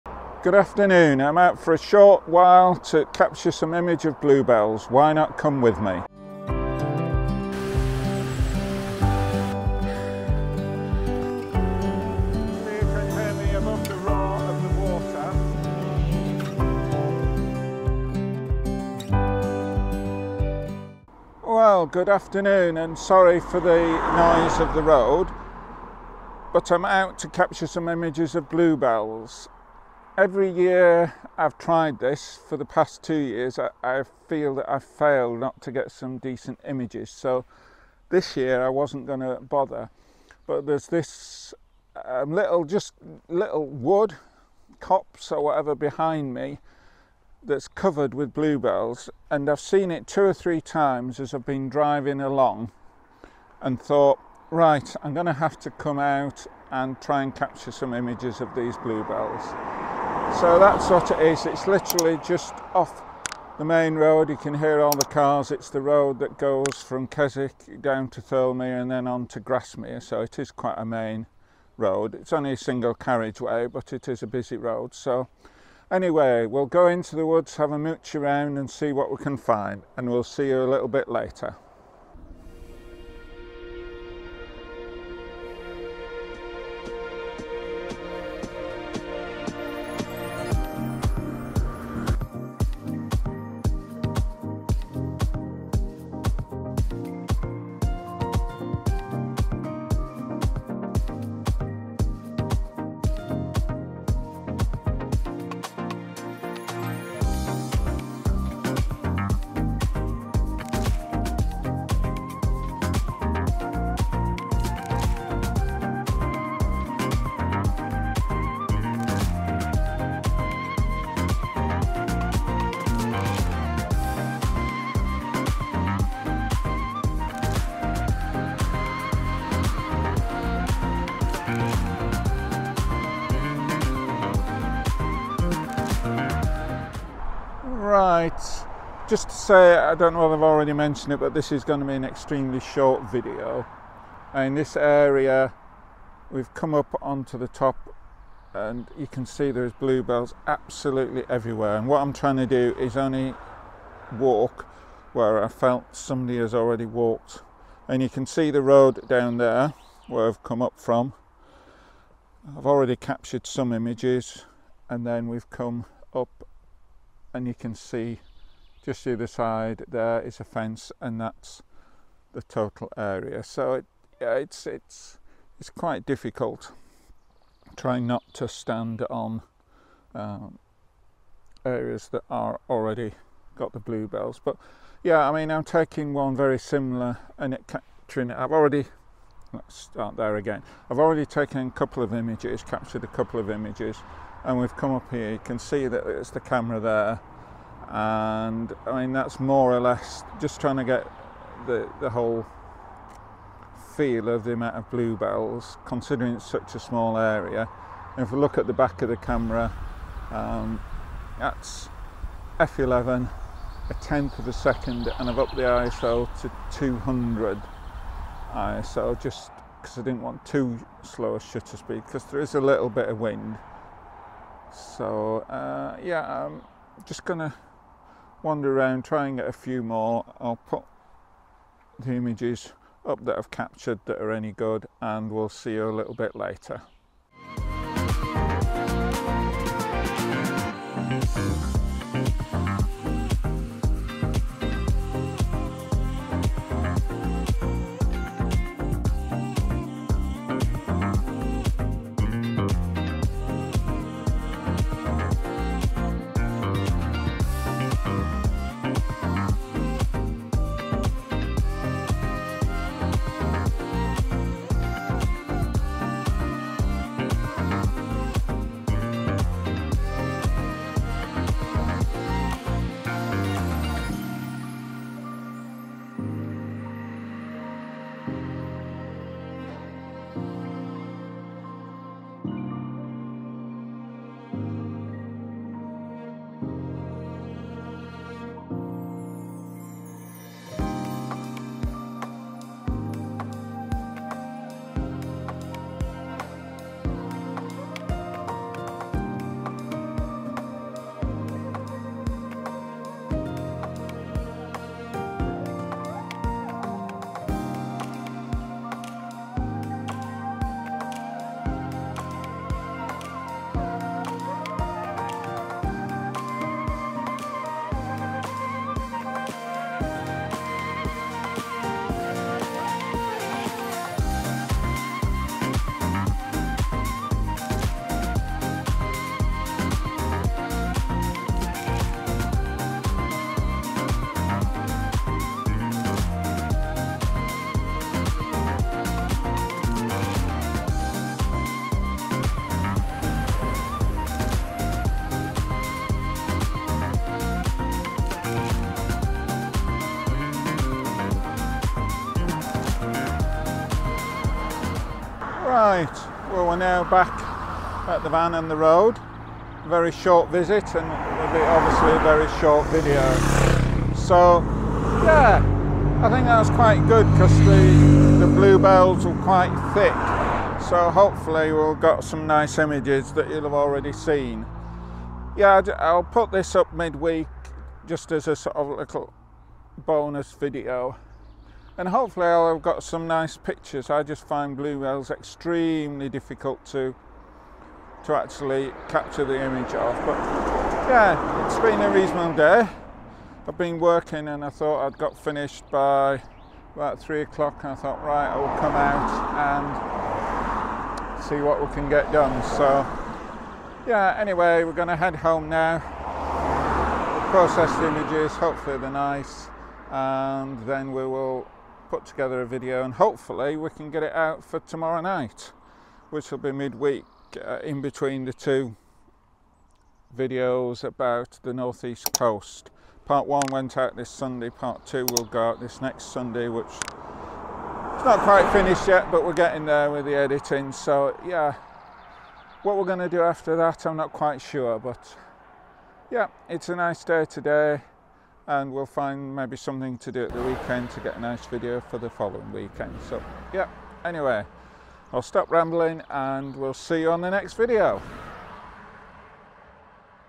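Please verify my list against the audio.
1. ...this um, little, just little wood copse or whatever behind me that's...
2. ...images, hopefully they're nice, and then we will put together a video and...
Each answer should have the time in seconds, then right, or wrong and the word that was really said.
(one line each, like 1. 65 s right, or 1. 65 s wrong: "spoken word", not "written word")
1. 40 s right
2. 408 s right.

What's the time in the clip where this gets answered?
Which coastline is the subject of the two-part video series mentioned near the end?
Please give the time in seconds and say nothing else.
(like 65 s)
421 s.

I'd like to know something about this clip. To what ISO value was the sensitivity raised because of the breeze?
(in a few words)
200.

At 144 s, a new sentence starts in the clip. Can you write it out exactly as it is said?
In this area, we've come up onto the top and you can see there's bluebells absolutely everywhere.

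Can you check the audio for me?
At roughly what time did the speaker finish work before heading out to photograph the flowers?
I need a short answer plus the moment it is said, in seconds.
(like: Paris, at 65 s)
3 o'clock, at 397 s.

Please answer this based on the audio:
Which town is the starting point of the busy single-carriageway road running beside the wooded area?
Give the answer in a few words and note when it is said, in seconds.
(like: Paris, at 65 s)
Keswick, at 67 s.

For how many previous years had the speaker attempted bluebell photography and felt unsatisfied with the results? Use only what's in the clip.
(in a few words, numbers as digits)
2.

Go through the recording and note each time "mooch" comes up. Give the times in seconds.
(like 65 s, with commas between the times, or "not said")
77 s.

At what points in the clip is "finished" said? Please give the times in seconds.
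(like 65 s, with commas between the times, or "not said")
395 s, 428 s.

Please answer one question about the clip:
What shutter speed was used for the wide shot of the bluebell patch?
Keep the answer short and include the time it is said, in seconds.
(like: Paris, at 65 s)
1/10 second, at 213 s.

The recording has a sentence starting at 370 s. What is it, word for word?
So hopefully we'll got some nice images that you'll have already seen.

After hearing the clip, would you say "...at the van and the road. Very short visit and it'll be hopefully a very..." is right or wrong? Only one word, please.
wrong.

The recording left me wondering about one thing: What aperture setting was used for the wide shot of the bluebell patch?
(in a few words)
f11.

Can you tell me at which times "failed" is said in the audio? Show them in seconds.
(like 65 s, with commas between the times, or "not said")
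34 s.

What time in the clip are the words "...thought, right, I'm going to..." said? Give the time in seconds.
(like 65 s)
53 s.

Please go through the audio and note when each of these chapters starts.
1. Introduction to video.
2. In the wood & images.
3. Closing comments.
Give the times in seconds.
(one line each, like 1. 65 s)
1. 21 s
2. 92 s
3. 355 s.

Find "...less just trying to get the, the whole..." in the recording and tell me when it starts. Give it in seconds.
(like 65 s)
199 s.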